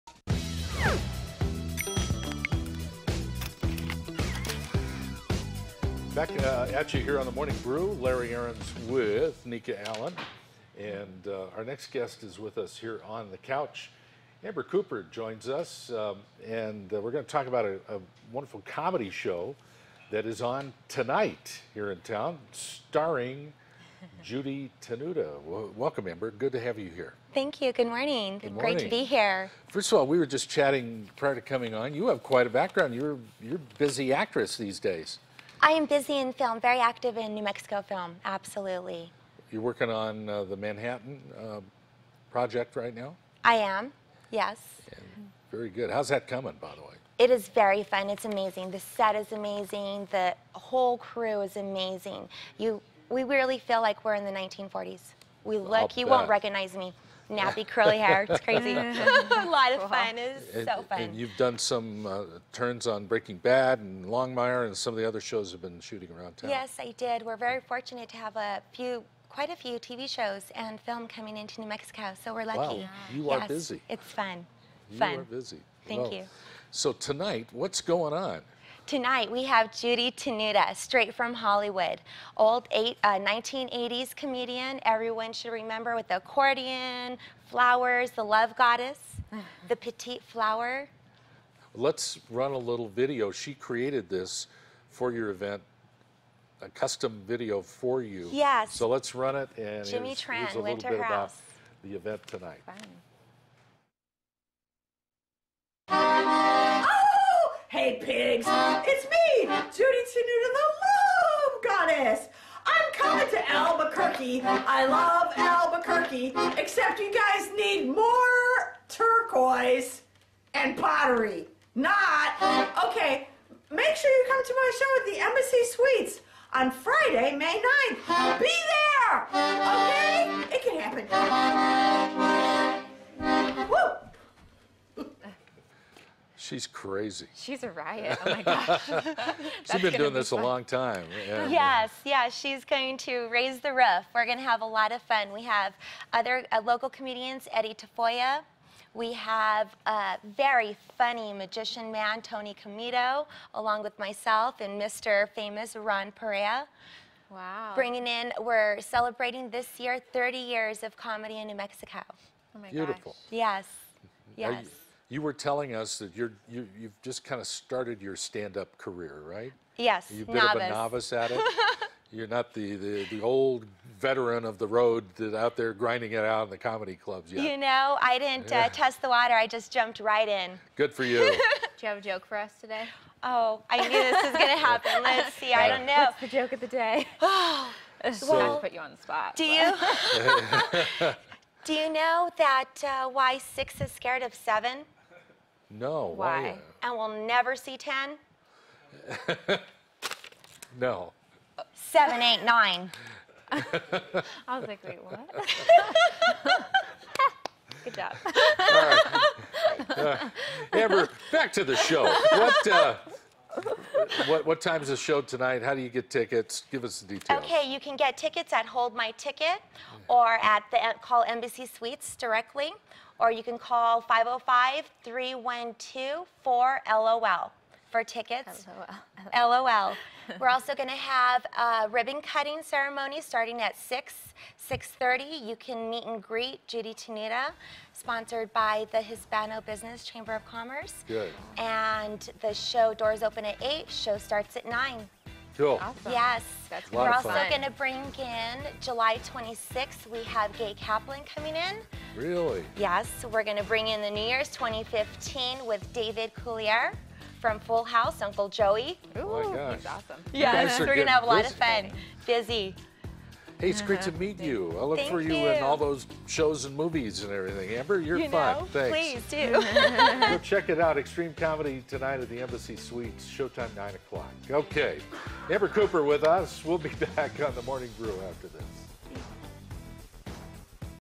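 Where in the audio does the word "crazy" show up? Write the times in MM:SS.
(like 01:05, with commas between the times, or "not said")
00:58, 02:16.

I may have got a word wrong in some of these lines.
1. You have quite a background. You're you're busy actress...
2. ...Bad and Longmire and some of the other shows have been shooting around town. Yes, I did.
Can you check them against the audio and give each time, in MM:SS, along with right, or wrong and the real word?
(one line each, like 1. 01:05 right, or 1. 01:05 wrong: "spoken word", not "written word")
1. 00:31 right
2. 01:03 right.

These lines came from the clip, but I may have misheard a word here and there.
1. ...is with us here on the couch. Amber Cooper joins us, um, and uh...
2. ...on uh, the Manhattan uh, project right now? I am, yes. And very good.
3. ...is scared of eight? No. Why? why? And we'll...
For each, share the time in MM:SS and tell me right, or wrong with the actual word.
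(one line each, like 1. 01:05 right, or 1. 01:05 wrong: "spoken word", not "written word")
1. 00:12 right
2. 00:39 right
3. 03:13 wrong: "seven", not "eight".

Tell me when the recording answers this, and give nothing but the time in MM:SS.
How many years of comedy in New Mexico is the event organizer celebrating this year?
02:40.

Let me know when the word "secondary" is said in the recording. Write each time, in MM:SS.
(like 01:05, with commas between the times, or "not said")
not said.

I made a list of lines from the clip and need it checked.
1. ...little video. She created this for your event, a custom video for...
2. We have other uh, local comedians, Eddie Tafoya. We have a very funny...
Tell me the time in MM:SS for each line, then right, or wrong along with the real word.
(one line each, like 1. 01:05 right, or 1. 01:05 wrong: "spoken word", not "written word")
1. 01:32 right
2. 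02:25 right.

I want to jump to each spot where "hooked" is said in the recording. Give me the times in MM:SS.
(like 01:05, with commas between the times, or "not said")
not said.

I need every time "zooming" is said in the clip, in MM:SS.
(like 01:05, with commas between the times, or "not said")
not said.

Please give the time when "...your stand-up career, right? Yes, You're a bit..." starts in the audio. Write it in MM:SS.
02:48.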